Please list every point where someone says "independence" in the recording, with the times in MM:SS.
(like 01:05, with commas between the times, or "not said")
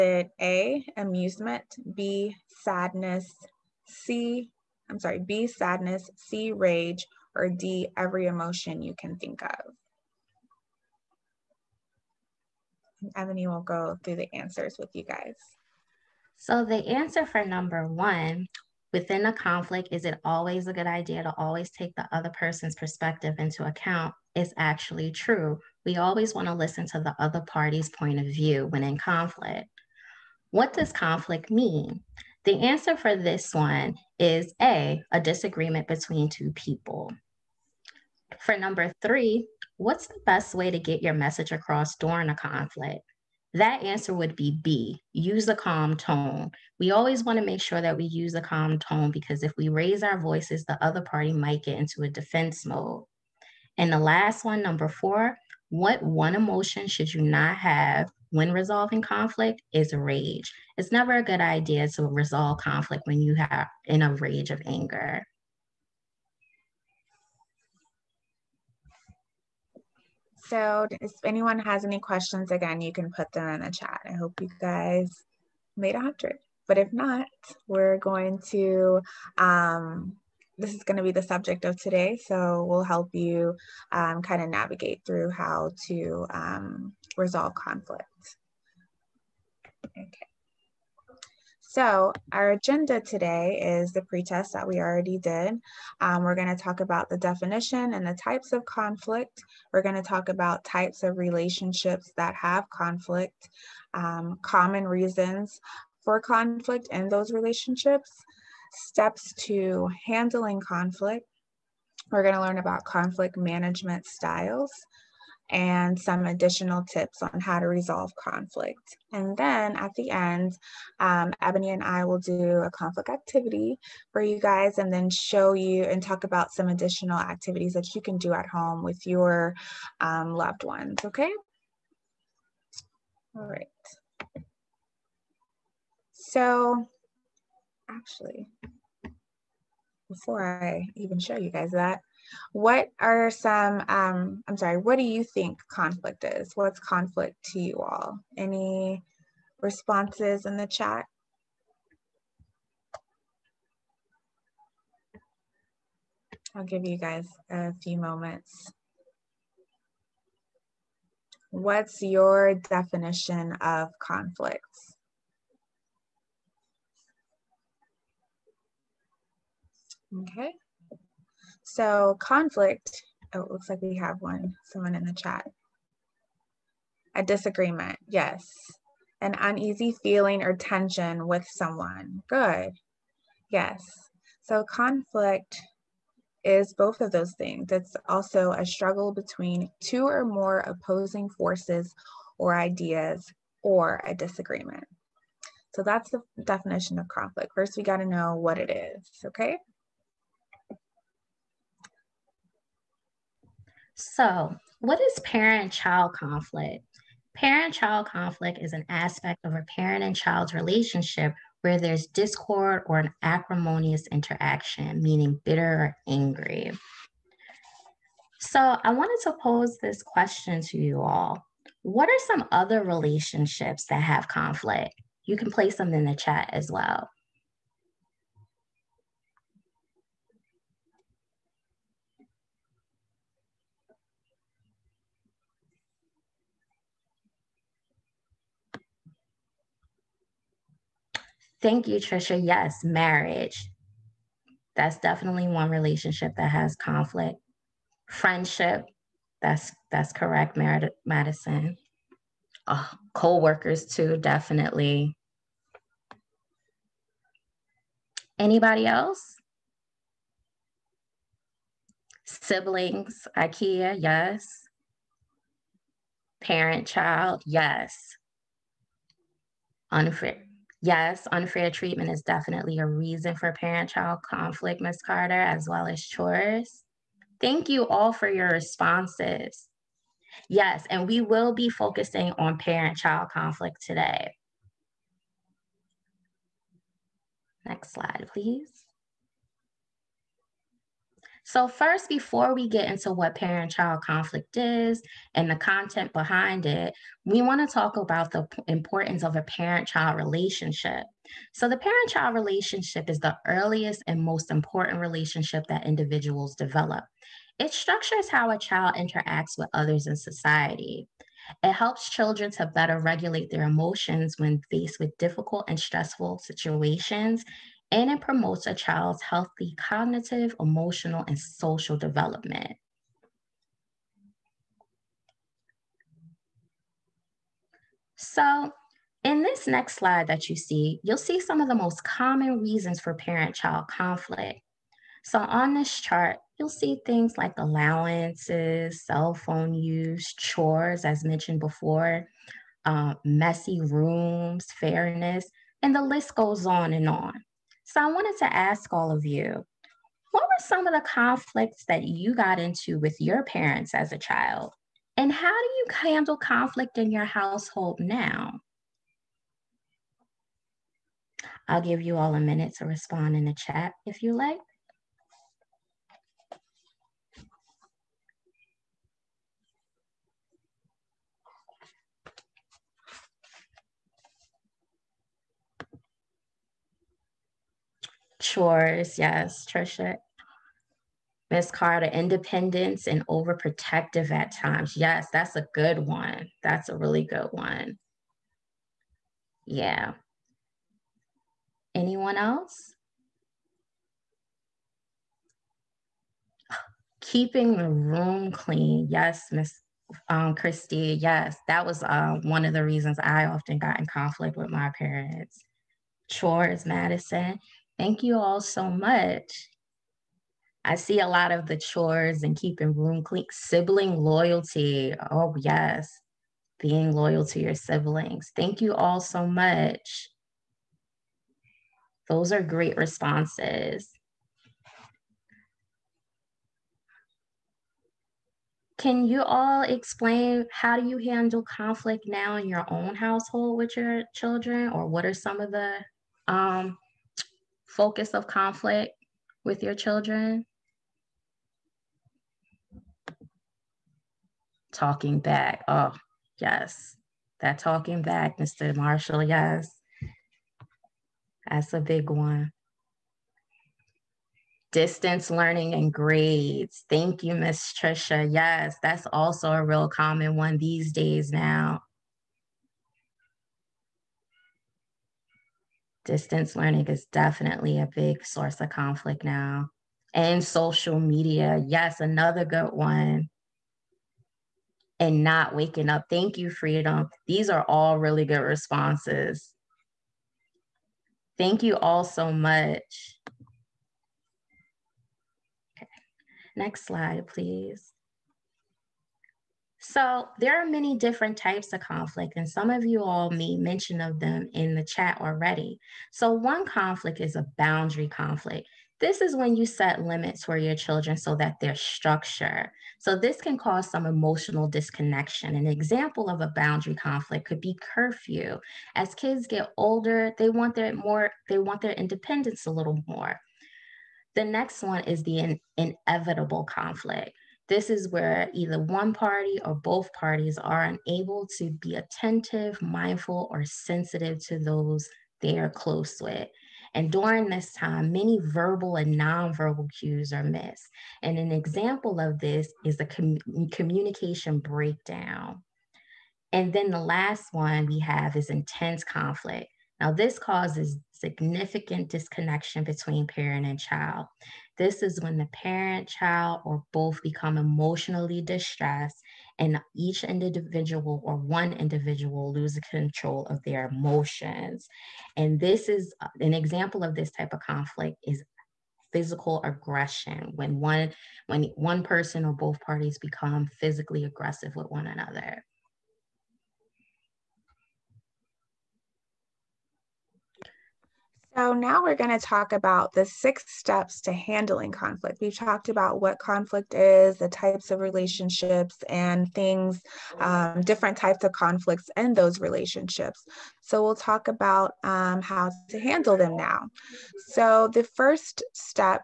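06:22, 08:32.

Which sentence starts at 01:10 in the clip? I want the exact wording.
So if anyone has any questions, again, you can put them in the chat.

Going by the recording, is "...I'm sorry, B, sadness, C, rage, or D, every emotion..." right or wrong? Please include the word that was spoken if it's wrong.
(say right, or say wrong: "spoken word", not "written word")
right.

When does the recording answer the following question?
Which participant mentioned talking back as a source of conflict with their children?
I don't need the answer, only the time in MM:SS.
07:28.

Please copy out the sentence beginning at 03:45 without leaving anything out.
You can place them in the chat as well.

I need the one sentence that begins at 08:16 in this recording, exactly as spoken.
So one conflict is a boundary conflict.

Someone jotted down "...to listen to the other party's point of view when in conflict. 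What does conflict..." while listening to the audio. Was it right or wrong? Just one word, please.
right.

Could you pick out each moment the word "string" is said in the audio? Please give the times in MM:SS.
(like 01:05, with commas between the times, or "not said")
not said.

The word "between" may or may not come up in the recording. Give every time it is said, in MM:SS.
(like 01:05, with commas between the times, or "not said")
00:35, 03:09, 09:03.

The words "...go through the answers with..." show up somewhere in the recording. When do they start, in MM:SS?
00:13.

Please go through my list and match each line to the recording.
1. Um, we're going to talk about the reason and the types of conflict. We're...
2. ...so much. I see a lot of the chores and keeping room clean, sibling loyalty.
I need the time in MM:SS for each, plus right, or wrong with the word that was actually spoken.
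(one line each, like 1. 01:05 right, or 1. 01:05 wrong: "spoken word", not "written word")
1. 01:35 wrong: "definition", not "reason"
2. 06:48 right.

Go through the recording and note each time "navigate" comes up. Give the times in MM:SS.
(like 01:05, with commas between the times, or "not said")
01:24.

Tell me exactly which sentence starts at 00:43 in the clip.
That answer would be B, use a calm tone.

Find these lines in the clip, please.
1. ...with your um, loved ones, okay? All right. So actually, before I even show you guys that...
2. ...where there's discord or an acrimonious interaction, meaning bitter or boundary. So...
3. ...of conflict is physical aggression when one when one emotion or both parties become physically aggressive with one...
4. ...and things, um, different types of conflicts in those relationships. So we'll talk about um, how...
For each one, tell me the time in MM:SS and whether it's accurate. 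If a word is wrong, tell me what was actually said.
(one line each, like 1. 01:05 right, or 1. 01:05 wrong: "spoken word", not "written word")
1. 02:08 right
2. 03:31 wrong: "angry", not "boundary"
3. 09:17 wrong: "person", not "emotion"
4. 09:39 right.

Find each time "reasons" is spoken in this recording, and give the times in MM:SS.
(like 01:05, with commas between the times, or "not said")
01:44, 04:32, 05:32, 06:42.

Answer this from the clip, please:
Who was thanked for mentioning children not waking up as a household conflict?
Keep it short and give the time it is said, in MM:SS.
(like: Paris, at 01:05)
Freedom, at 07:56.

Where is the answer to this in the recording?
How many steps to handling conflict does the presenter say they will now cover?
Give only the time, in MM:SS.
09:33.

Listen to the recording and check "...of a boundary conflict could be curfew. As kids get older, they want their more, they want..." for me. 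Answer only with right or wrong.
right.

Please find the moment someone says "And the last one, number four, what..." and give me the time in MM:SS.
00:53.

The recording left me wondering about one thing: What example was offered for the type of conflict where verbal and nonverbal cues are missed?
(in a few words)
Communication breakdown.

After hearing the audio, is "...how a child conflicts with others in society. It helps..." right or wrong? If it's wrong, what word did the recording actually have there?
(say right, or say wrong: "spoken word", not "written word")
wrong: "interacts", not "conflicts".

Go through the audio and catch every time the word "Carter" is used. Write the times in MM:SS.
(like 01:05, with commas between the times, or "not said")
04:35, 06:21.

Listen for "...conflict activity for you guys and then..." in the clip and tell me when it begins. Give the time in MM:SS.
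02:02.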